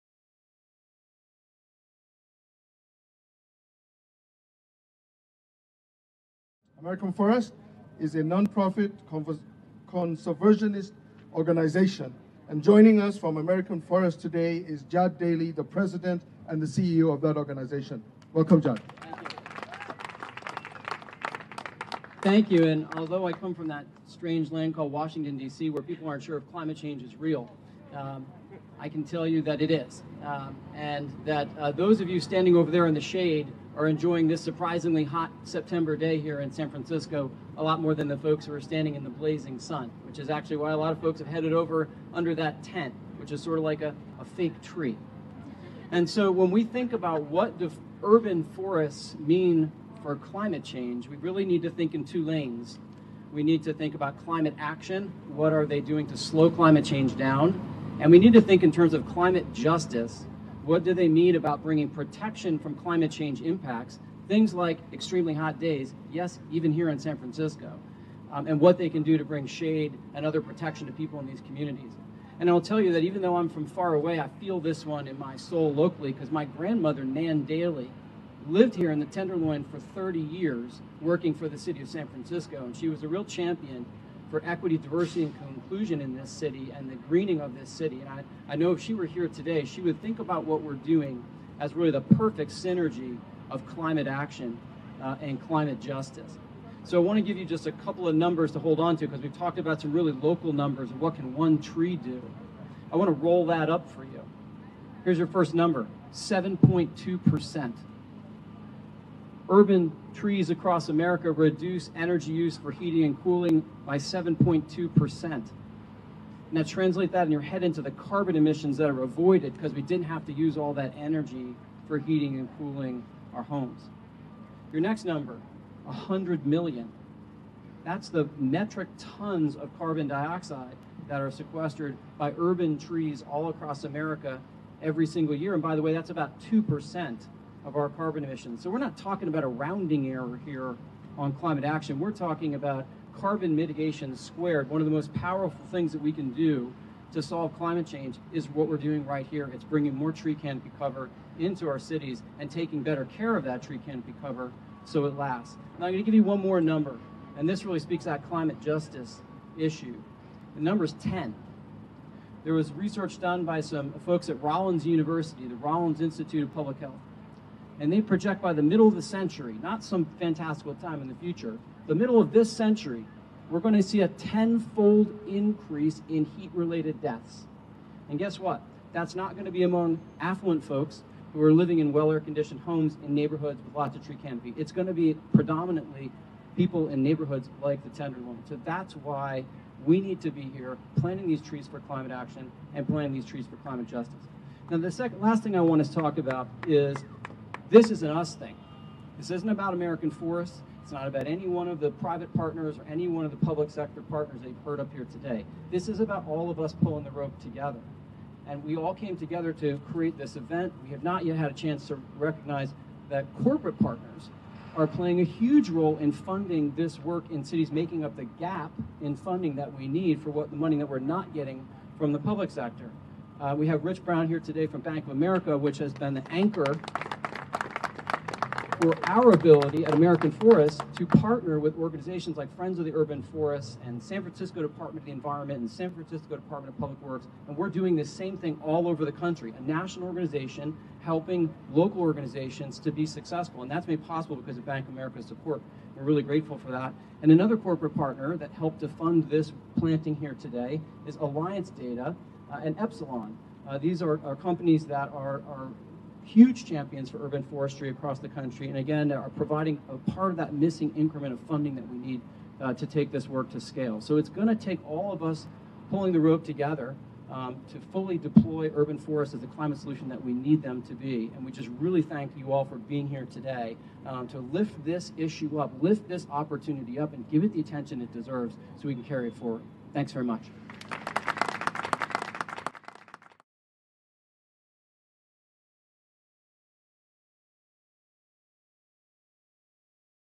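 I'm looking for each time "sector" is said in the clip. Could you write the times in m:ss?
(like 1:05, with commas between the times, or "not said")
3:23, 3:42.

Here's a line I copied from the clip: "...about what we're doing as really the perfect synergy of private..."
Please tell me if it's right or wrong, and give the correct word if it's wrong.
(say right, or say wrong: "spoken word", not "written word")
wrong: "climate", not "private".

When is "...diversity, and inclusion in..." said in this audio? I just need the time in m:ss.
1:24.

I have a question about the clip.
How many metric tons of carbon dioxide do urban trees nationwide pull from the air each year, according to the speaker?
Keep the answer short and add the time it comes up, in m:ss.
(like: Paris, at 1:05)
100 million, at 2:05.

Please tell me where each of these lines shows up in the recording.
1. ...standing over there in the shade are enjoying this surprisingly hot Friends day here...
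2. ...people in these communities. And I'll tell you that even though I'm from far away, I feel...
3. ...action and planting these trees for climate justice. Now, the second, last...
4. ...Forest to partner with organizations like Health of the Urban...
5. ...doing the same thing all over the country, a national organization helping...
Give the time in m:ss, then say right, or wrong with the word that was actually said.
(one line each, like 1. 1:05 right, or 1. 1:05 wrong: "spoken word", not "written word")
1. 0:32 wrong: "September", not "Friends"
2. 1:10 right
3. 3:12 right
4. 3:50 wrong: "Friends", not "Health"
5. 3:57 right.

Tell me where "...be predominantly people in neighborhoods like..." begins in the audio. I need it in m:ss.
3:04.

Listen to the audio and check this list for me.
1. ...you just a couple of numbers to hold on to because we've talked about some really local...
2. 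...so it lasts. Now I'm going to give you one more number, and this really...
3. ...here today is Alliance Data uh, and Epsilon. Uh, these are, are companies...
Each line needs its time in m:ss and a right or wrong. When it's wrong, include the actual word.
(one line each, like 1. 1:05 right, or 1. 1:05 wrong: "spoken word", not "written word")
1. 1:37 right
2. 2:34 right
3. 4:10 right.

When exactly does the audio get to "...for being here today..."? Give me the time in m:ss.
4:32.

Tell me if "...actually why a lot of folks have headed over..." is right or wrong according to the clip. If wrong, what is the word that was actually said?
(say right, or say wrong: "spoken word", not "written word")
right.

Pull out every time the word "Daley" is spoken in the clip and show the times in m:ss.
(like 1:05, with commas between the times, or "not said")
0:15, 1:17.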